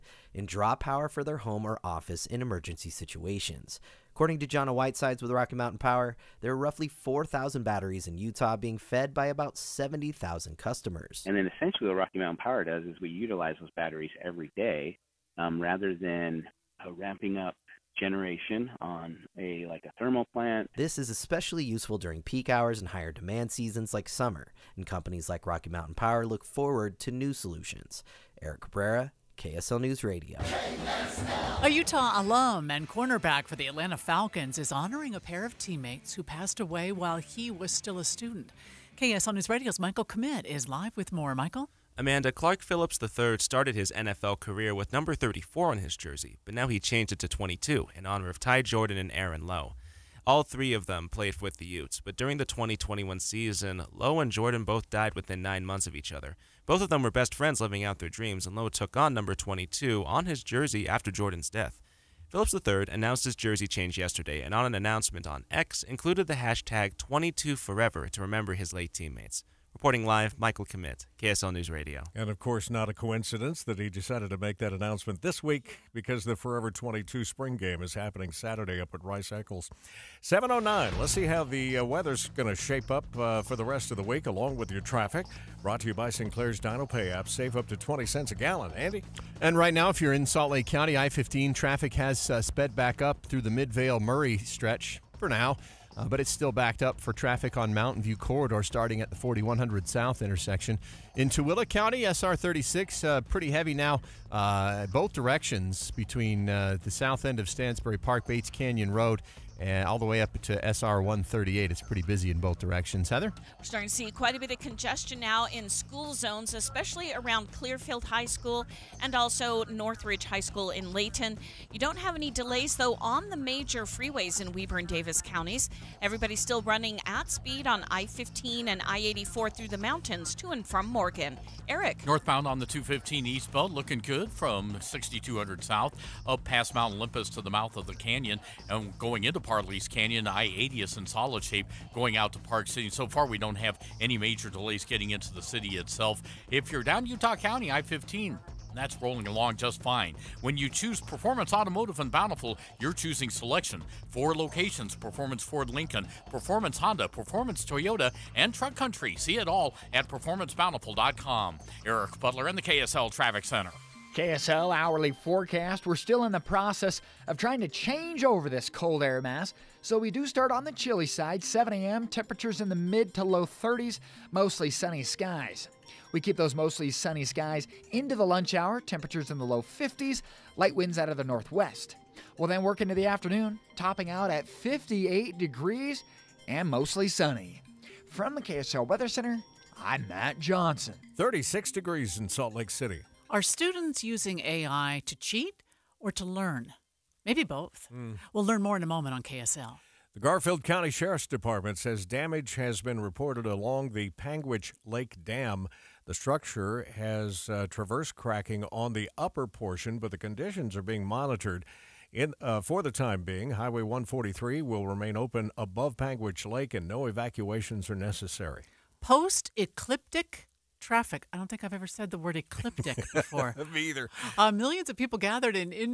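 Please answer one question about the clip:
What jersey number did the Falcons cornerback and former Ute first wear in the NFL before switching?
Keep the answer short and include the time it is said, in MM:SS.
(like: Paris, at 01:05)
34, at 00:45.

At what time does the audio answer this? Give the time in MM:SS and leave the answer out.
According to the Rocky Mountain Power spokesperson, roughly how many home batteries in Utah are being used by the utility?
00:06.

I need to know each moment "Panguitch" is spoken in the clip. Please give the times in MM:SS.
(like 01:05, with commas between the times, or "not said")
03:24, 03:35.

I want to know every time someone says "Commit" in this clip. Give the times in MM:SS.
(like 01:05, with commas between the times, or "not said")
00:40, 01:10.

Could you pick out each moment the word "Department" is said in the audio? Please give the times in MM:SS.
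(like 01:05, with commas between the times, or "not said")
03:21.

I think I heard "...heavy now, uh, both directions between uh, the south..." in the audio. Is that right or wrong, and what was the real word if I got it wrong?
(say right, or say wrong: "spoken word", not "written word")
right.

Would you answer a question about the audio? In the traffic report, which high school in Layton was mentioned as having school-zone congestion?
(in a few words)
Northridge High School.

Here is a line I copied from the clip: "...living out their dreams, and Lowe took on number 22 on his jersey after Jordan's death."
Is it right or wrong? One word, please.
right.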